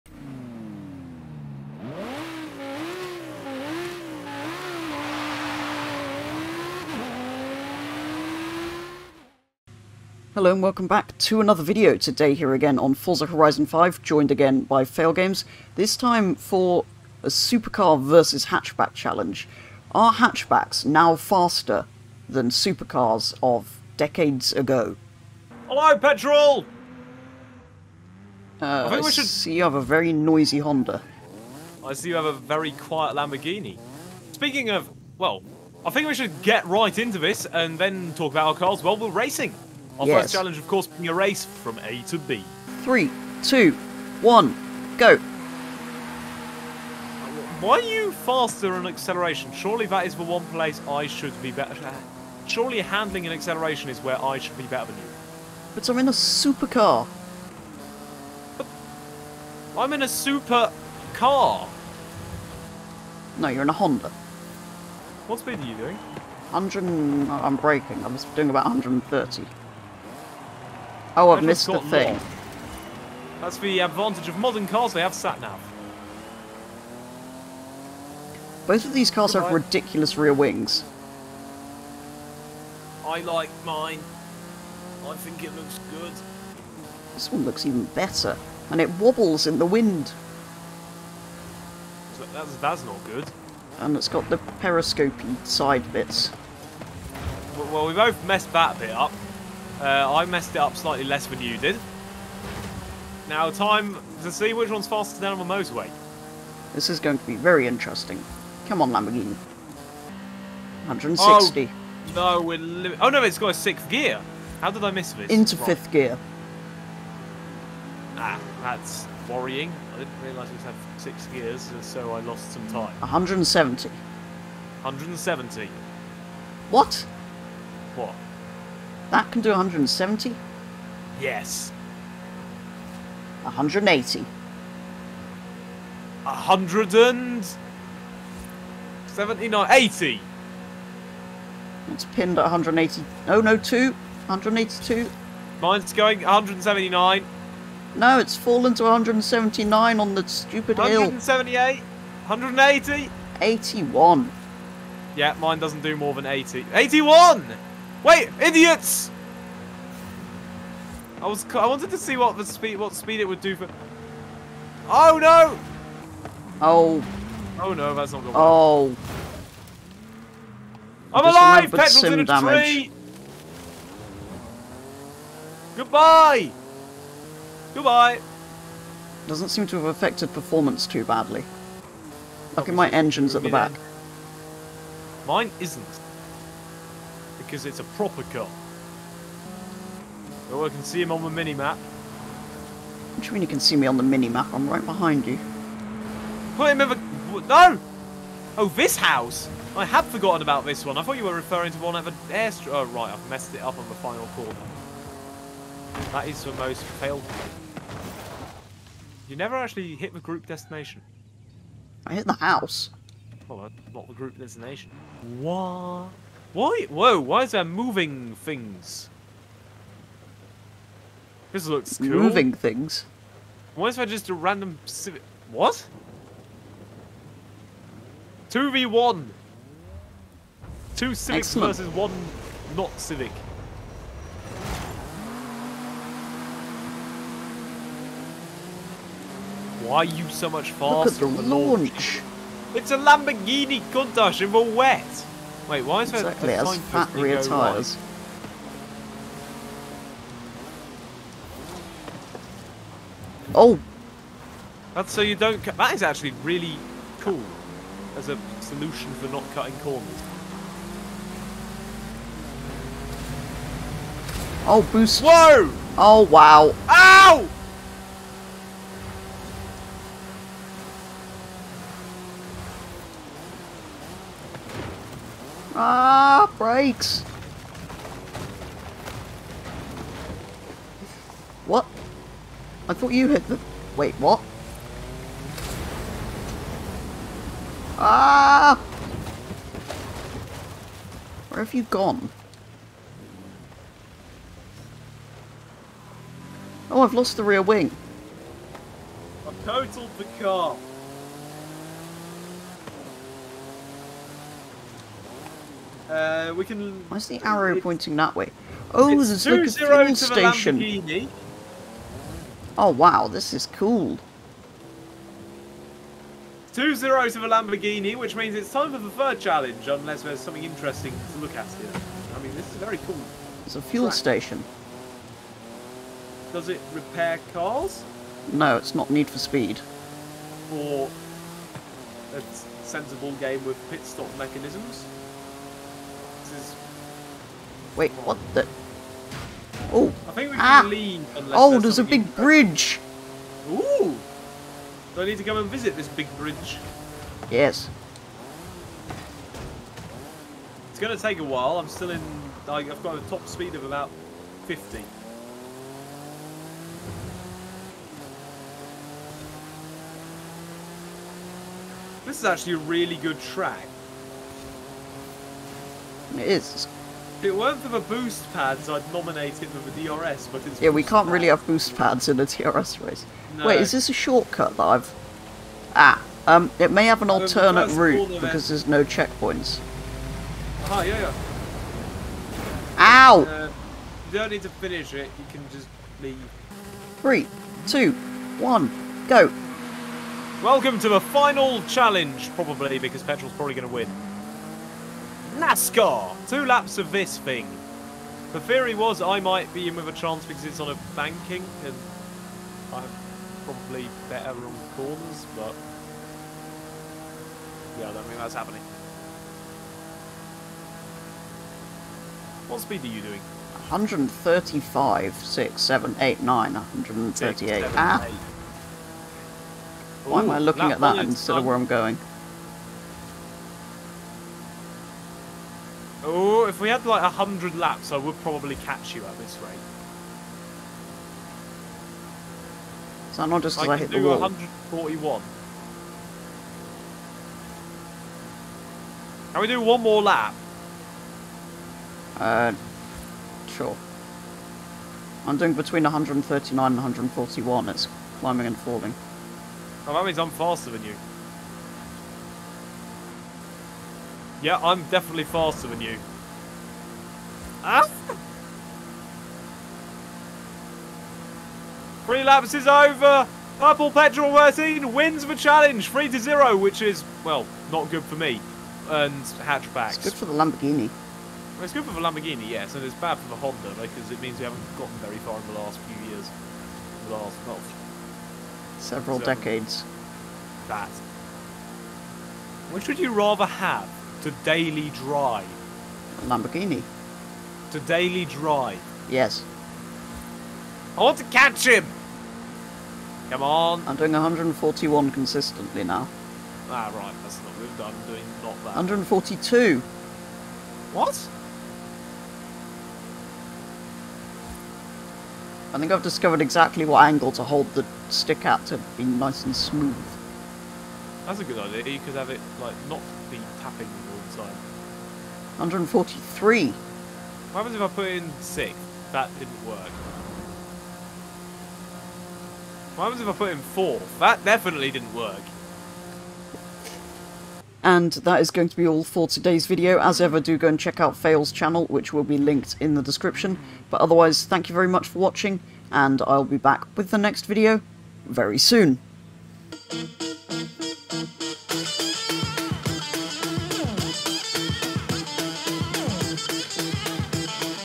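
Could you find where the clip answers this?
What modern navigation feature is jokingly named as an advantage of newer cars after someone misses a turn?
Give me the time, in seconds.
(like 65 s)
75 s.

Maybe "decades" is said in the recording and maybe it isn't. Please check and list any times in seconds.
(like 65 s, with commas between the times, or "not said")
23 s, 479 s.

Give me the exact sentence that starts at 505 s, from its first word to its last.
I think I've discovered exactly what angle to hold the stick at to be nice and smooth.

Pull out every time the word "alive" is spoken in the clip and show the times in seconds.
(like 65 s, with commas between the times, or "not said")
171 s.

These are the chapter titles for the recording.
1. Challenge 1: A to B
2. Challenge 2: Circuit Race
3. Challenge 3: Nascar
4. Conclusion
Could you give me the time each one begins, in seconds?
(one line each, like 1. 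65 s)
1. 42 s
2. 215 s
3. 387 s
4. 463 s.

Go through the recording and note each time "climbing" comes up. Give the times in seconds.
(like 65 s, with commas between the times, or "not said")
448 s.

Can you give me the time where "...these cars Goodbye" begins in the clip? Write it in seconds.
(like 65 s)
78 s.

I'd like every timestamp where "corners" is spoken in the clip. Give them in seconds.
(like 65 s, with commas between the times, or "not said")
204 s, 259 s, 404 s.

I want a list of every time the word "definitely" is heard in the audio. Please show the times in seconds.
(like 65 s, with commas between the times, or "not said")
455 s, 524 s.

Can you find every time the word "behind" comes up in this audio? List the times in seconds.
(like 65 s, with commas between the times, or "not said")
194 s.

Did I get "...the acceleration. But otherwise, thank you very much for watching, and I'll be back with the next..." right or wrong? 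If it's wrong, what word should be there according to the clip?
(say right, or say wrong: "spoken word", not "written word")
wrong: "description", not "acceleration".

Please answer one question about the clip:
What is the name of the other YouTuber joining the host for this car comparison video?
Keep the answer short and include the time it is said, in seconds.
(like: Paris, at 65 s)
Failgames, at 14 s.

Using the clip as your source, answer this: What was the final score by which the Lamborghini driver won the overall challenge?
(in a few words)
3 to 0.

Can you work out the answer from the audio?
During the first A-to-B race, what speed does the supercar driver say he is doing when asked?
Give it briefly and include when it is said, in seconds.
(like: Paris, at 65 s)
130, at 68 s.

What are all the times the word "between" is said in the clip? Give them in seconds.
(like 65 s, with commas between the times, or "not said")
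445 s.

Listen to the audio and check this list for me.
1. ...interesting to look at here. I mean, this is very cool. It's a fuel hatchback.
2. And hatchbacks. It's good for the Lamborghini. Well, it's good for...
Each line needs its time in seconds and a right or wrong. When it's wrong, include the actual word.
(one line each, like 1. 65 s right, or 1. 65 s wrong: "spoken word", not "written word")
1. 320 s wrong: "track", not "hatchback"
2. 469 s right.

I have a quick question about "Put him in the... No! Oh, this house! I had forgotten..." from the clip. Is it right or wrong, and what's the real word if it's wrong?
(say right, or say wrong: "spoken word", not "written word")
right.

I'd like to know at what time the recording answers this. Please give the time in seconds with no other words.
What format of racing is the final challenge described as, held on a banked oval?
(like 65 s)
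395 s.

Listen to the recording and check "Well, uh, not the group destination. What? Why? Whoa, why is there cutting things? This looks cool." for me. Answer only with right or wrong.
wrong.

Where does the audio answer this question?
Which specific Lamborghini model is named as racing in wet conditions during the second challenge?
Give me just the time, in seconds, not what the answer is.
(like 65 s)
243 s.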